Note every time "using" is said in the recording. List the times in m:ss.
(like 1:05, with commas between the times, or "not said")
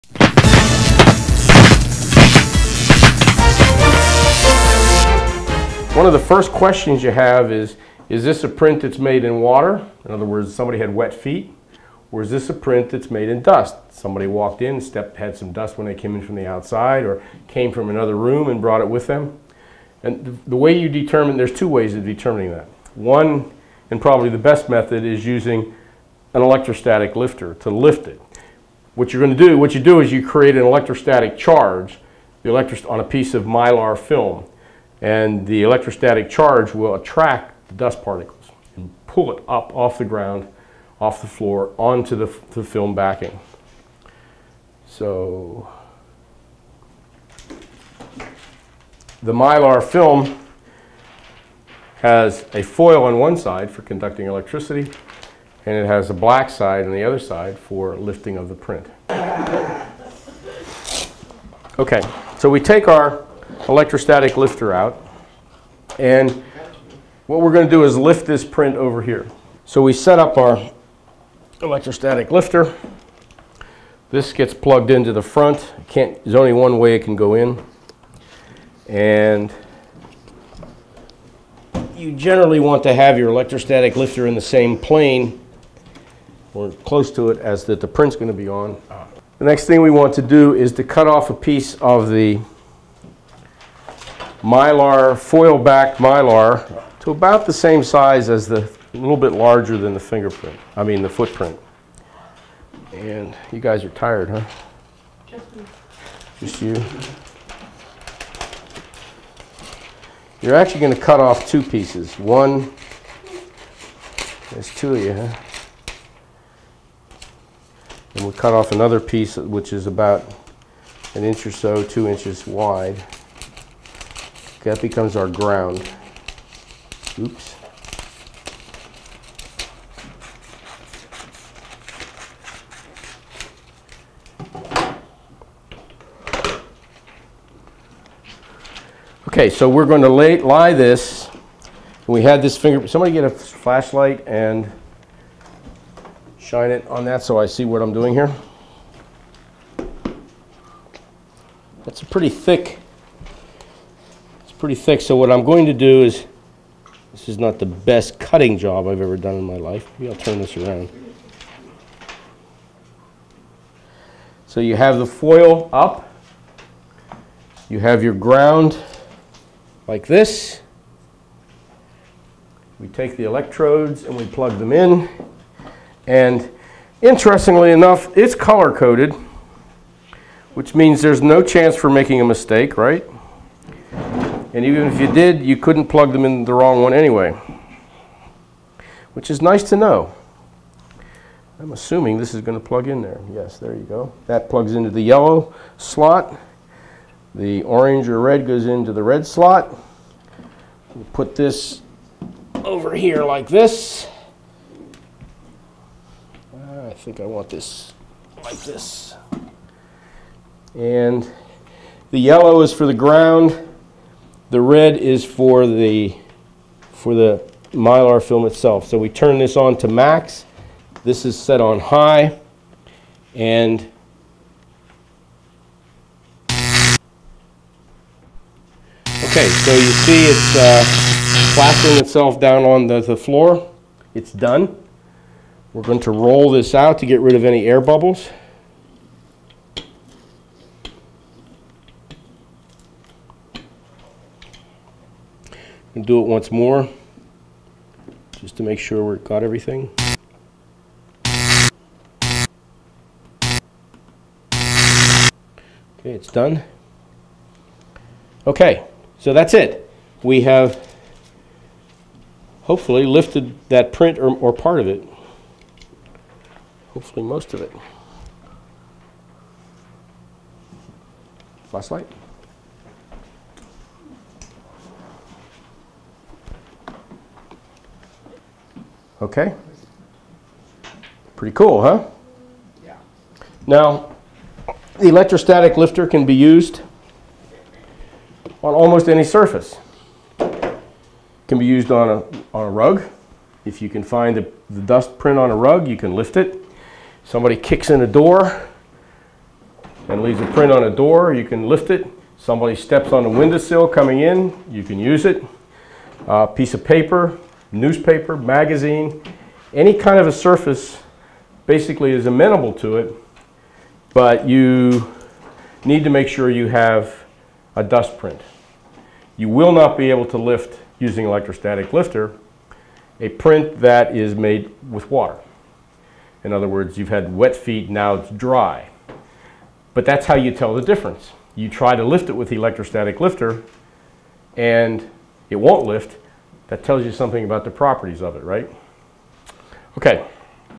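0:25, 5:20.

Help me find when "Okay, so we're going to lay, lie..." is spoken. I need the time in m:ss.
2:19.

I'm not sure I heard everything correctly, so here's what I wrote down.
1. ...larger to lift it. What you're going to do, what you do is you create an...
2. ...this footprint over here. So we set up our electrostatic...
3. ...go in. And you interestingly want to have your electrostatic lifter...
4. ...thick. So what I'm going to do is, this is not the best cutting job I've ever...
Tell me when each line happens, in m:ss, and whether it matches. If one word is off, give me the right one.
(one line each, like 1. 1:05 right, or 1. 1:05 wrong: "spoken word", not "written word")
1. 0:27 wrong: "lifter", not "larger"
2. 1:08 wrong: "print", not "footprint"
3. 1:17 wrong: "generally", not "interestingly"
4. 2:34 right.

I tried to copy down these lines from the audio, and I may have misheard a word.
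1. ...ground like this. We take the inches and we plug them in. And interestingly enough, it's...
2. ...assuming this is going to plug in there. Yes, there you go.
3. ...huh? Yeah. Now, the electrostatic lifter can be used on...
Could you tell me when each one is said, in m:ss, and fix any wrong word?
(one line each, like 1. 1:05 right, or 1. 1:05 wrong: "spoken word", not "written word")
1. 2:48 wrong: "electrodes", not "inches"
2. 3:11 right
3. 4:41 right.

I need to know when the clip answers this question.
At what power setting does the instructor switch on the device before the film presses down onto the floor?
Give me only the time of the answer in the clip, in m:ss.
3:39.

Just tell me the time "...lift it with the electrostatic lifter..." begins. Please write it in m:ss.
5:32.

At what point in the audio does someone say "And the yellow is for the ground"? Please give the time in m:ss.
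3:30.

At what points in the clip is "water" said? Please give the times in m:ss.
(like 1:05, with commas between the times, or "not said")
0:09, 5:25.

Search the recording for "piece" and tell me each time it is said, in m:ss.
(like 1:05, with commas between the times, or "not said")
0:33, 1:31, 1:51, 1:58, 5:06.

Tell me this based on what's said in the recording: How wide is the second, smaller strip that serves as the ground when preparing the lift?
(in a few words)
two inches.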